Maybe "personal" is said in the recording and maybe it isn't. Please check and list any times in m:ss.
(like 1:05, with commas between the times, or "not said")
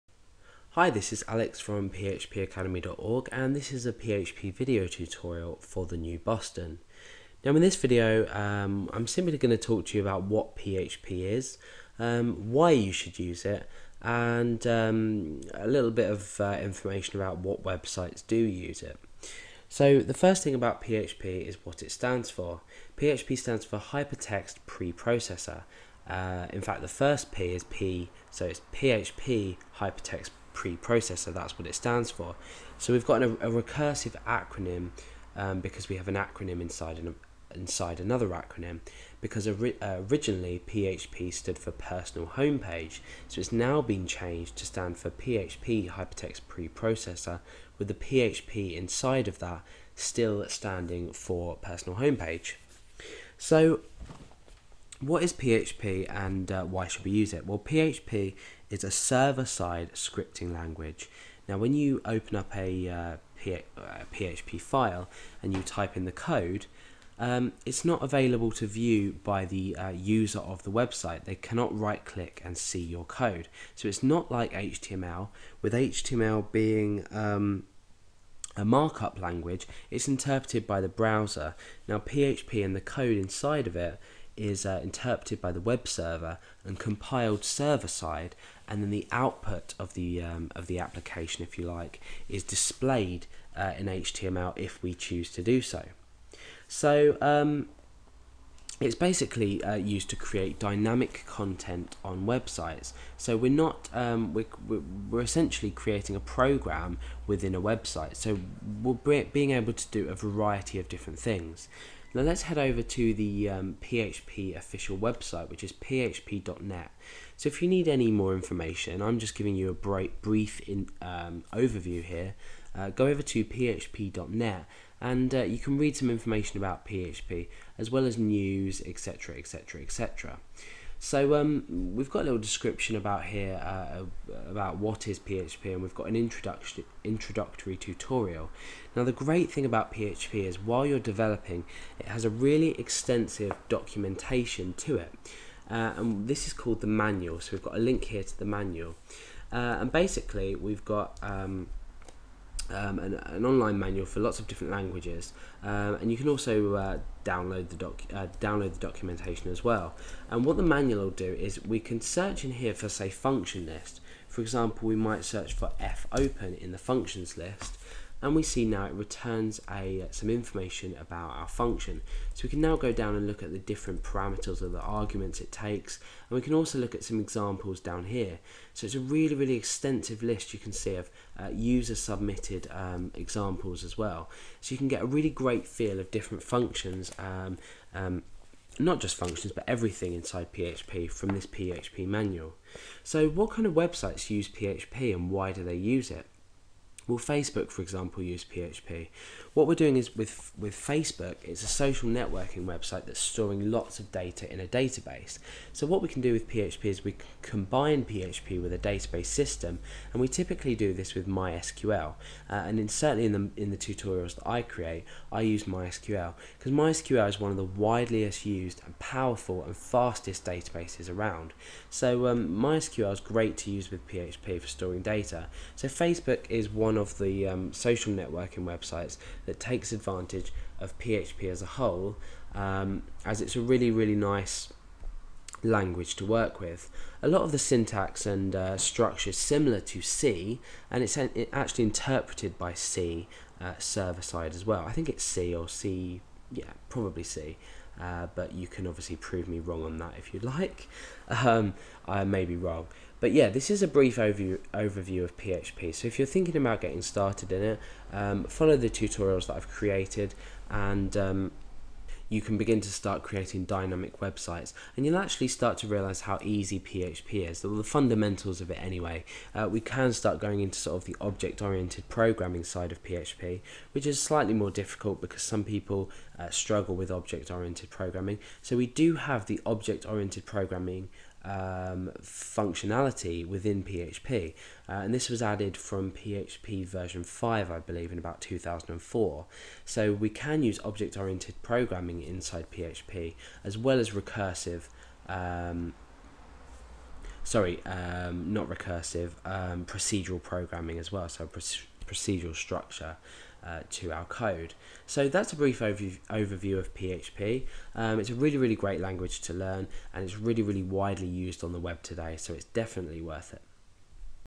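0:41, 0:51.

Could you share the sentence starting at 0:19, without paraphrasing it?
So the first thing about PHP is what it stands for.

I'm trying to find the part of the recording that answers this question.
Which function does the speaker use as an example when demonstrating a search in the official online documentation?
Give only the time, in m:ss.
2:45.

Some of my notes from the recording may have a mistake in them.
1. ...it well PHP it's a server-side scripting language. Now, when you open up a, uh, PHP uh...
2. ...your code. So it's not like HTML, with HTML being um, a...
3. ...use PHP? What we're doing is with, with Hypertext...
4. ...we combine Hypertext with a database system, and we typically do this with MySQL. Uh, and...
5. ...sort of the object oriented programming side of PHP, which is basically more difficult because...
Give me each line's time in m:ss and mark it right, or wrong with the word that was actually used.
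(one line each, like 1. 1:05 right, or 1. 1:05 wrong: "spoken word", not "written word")
1. 0:57 right
2. 1:12 right
3. 3:18 wrong: "Facebook", not "Hypertext"
4. 3:27 wrong: "PHP", not "Hypertext"
5. 4:30 wrong: "slightly", not "basically".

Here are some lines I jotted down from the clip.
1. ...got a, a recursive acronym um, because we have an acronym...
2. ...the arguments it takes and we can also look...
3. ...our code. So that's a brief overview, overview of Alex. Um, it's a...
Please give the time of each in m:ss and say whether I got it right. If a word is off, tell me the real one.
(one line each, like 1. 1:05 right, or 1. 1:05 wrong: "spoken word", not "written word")
1. 0:33 right
2. 2:54 right
3. 5:04 wrong: "PHP", not "Alex".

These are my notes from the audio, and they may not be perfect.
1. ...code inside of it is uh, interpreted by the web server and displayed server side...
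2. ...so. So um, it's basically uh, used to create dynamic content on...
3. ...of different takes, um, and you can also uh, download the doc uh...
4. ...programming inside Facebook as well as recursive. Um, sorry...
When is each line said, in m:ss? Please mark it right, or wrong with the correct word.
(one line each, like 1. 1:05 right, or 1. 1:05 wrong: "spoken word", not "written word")
1. 1:22 wrong: "compiled", not "displayed"
2. 1:35 right
3. 2:34 wrong: "languages", not "takes"
4. 4:51 wrong: "PHP", not "Facebook".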